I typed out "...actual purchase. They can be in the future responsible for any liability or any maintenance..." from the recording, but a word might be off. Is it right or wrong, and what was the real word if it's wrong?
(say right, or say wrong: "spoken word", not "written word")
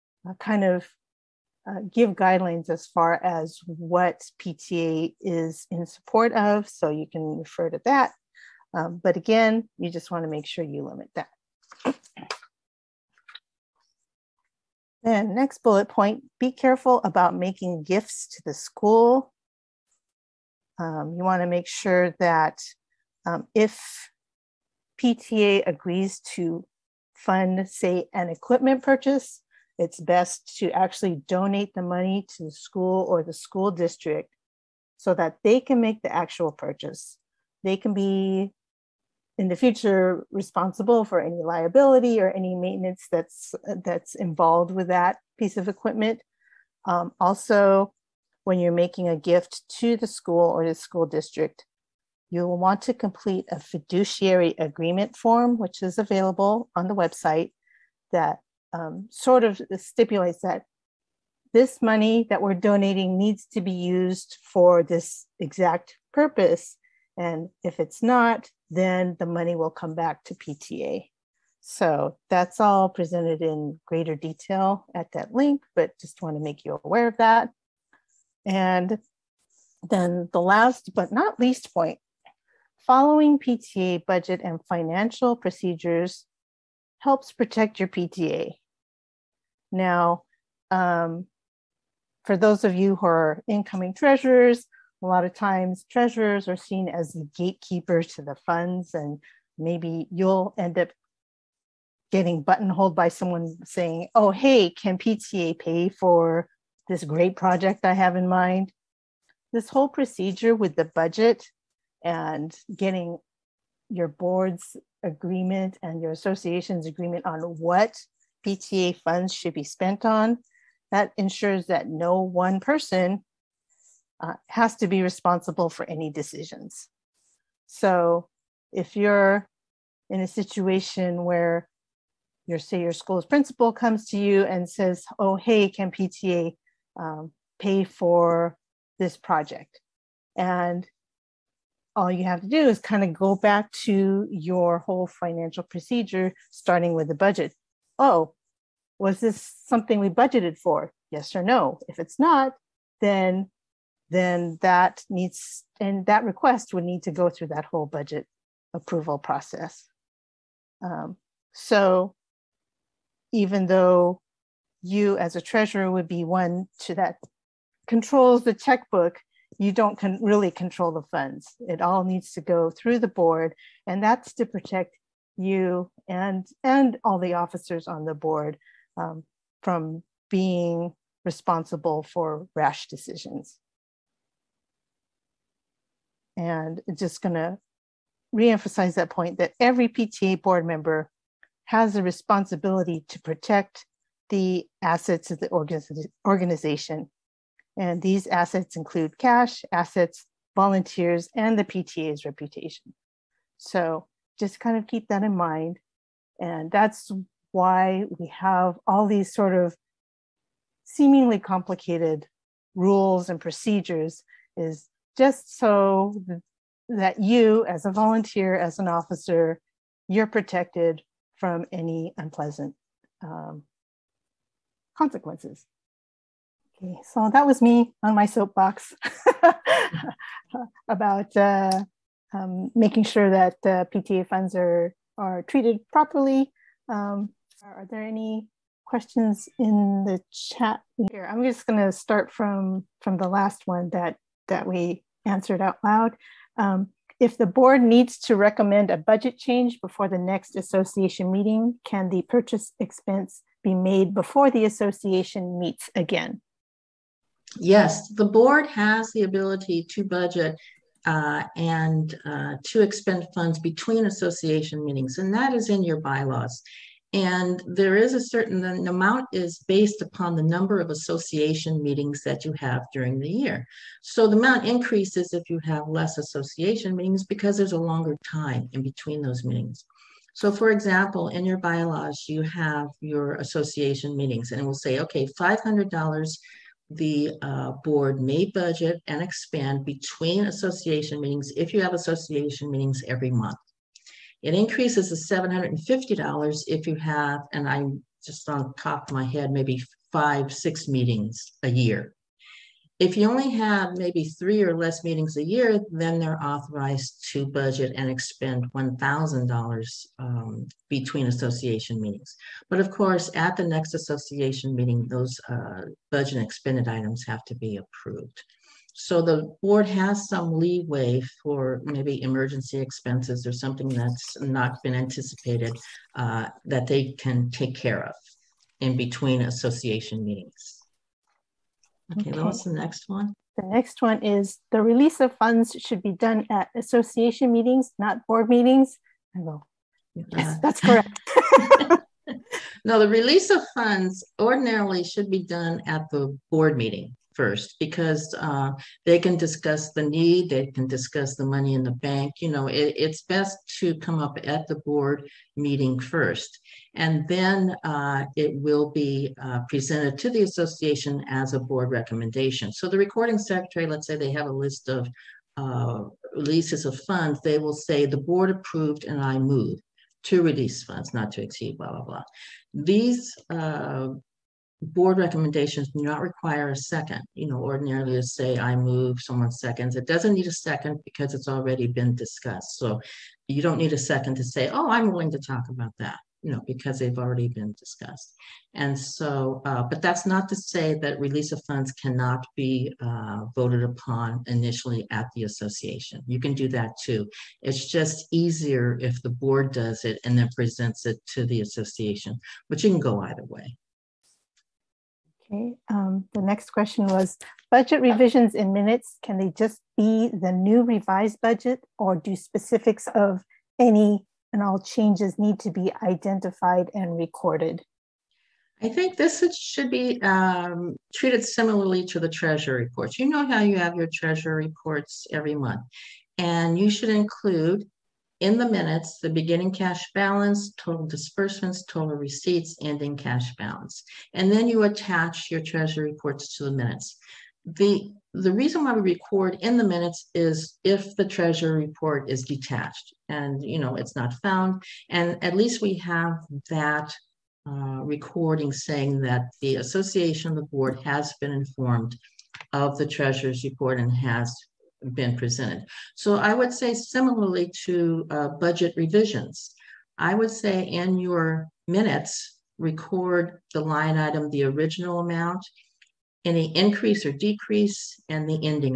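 right.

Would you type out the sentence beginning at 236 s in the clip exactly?
Um, are there any questions in the chat here?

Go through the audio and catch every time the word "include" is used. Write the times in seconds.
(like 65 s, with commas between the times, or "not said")
198 s, 427 s.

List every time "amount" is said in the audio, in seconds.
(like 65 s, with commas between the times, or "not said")
268 s, 274 s, 465 s.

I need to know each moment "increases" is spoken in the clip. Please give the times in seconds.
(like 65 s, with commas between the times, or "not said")
274 s, 294 s, 466 s.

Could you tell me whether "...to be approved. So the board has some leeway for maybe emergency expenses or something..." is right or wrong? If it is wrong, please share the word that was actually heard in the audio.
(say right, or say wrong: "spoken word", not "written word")
right.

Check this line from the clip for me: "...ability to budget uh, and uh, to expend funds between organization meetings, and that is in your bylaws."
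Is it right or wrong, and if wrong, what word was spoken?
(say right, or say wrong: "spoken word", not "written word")
wrong: "association", not "organization".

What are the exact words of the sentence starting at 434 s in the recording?
And then you attach your treasury reports to the minutes.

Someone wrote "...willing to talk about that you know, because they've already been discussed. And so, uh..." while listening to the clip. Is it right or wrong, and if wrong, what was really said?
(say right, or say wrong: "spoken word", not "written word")
right.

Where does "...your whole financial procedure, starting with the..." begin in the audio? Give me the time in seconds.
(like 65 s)
144 s.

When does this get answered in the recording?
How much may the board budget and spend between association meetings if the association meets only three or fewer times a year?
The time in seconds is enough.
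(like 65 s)
308 s.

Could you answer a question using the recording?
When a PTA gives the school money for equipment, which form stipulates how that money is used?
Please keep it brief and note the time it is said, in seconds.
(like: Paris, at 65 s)
fiduciary agreement form, at 53 s.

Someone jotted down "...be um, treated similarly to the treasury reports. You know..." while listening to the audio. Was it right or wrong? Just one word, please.
right.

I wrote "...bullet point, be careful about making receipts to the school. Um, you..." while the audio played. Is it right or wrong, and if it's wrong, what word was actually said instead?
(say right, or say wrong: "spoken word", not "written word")
wrong: "gifts", not "receipts".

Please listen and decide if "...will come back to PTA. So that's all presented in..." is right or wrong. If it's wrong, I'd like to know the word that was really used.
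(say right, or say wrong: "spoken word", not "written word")
right.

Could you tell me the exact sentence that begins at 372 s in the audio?
These uh, board recommendations do not require a second.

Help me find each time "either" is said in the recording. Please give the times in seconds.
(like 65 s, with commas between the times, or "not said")
403 s.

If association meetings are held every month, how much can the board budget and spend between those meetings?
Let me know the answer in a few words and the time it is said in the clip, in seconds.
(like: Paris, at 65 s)
$500, at 285 s.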